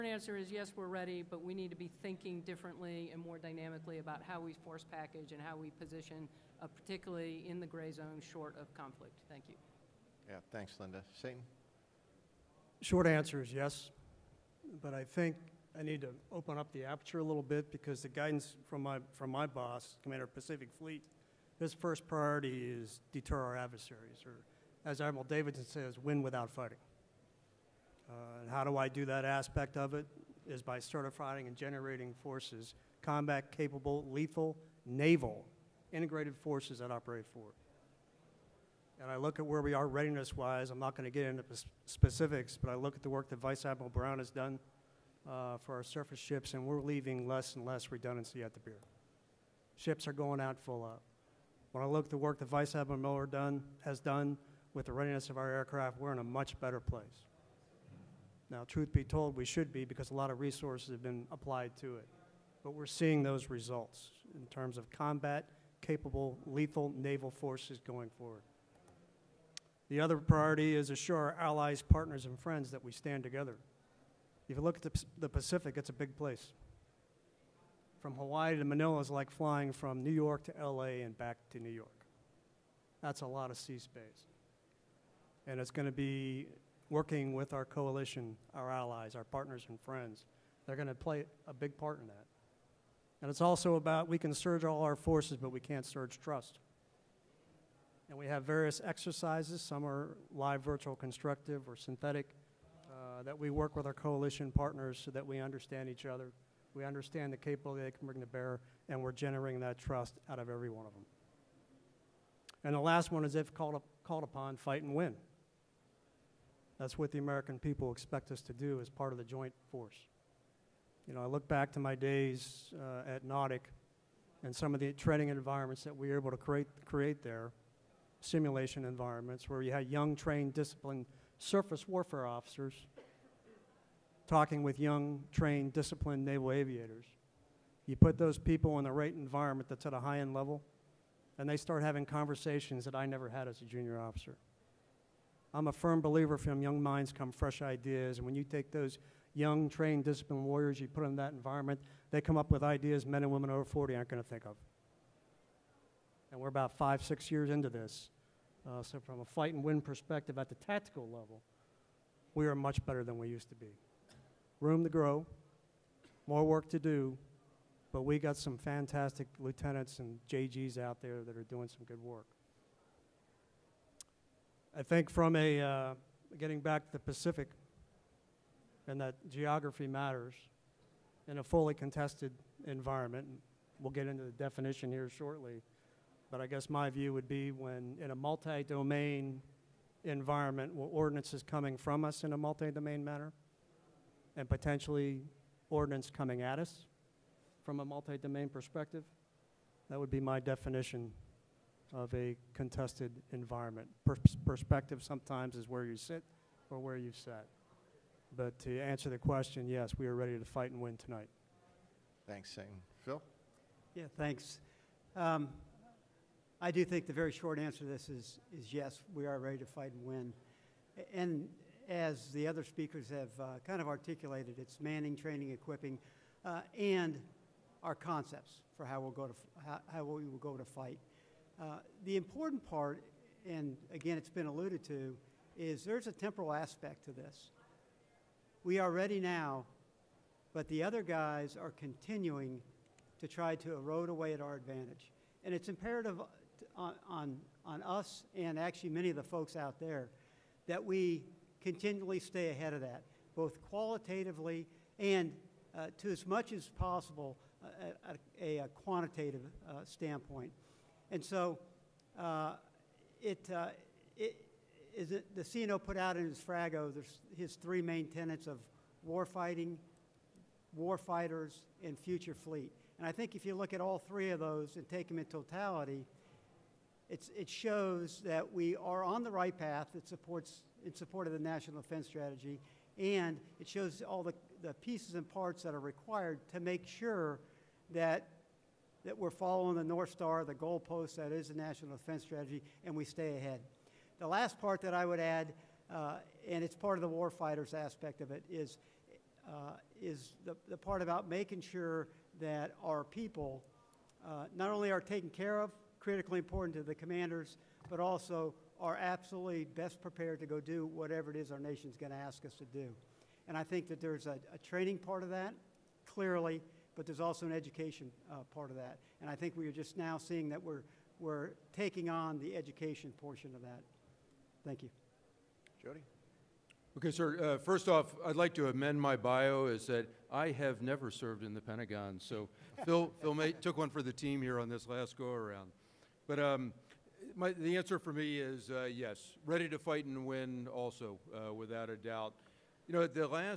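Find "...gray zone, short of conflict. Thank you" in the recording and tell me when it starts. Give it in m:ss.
0:07.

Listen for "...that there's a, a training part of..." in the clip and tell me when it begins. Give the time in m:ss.
5:13.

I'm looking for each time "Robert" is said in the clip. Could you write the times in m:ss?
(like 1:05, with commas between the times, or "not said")
not said.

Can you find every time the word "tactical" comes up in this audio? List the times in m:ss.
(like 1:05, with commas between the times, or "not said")
2:40.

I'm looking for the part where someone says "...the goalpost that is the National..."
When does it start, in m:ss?
4:50.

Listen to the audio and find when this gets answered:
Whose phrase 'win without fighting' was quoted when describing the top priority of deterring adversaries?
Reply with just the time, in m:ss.
0:25.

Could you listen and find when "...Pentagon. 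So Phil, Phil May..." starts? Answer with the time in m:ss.
5:31.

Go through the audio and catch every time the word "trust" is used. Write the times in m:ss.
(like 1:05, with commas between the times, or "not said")
1:36, 1:49.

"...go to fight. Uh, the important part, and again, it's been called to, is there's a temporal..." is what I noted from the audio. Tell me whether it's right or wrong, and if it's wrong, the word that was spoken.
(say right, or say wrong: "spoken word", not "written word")
wrong: "alluded", not "called".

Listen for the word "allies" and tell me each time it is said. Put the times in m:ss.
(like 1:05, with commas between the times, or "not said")
1:11, 1:28.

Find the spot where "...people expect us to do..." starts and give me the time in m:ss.
1:57.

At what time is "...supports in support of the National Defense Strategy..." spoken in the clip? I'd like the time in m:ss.
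4:40.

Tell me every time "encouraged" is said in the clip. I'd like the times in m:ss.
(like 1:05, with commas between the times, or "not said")
not said.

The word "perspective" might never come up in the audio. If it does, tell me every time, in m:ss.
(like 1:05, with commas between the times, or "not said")
2:39, 3:18, 3:24.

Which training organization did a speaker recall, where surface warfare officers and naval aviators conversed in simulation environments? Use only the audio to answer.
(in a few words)
NAWDC.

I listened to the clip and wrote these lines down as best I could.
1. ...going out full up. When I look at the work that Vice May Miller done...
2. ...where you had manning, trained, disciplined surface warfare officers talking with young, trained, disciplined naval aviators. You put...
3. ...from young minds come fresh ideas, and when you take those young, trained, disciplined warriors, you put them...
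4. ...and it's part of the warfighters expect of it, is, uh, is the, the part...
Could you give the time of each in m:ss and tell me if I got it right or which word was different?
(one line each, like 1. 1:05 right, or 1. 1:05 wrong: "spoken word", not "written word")
1. 0:50 wrong: "Admiral", not "May"
2. 2:09 wrong: "young", not "manning"
3. 2:26 right
4. 4:56 wrong: "aspect", not "expect".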